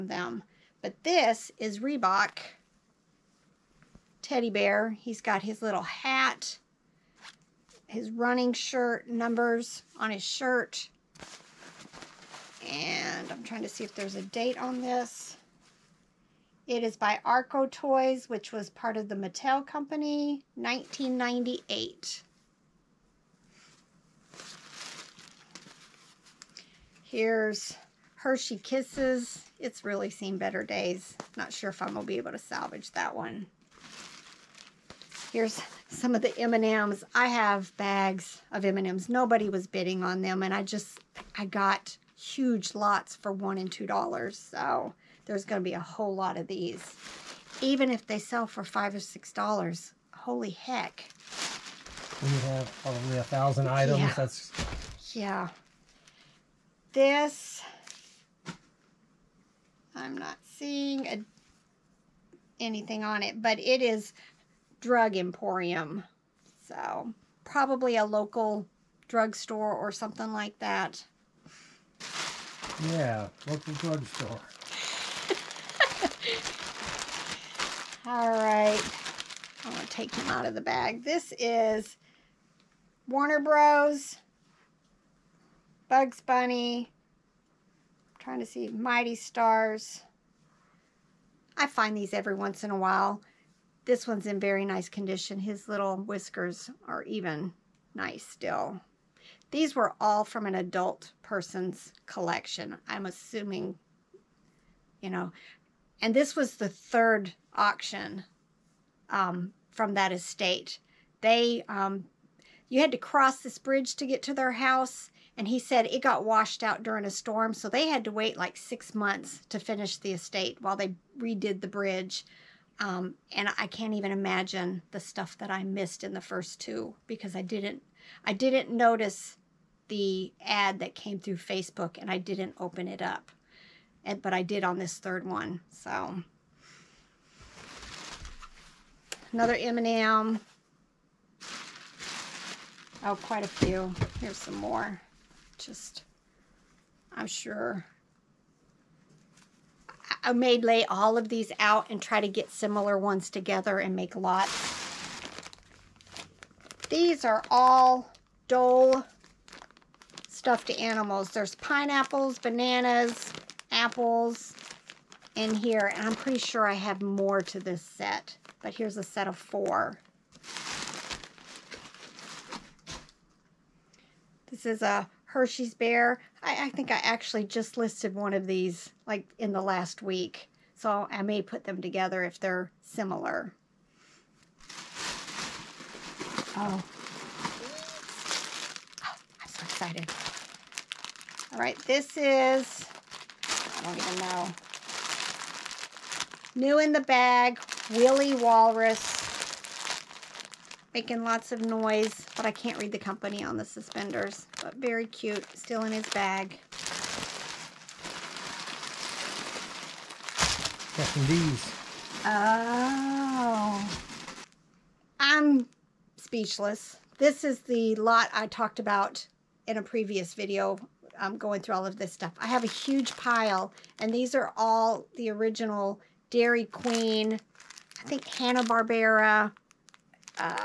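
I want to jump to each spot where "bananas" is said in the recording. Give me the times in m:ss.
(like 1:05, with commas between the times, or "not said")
2:42.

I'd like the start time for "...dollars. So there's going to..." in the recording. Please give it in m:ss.
0:43.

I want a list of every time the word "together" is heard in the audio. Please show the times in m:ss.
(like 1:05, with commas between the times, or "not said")
2:33, 3:01.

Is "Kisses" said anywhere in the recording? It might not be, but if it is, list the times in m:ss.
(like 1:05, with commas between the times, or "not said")
0:28.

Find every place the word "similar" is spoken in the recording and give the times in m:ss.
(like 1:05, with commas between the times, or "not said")
2:32, 3:02.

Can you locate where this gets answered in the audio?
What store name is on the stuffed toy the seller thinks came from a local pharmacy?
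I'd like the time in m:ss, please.
1:04.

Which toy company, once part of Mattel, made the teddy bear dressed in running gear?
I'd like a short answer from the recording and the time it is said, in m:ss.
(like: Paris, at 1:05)
Arco Toys, at 0:17.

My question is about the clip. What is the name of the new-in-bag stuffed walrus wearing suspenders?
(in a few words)
Willy Walrus.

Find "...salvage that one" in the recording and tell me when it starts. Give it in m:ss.
0:32.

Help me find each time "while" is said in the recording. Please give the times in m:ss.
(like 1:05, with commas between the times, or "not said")
1:32, 2:00.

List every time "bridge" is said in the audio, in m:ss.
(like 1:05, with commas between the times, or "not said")
1:53, 2:01.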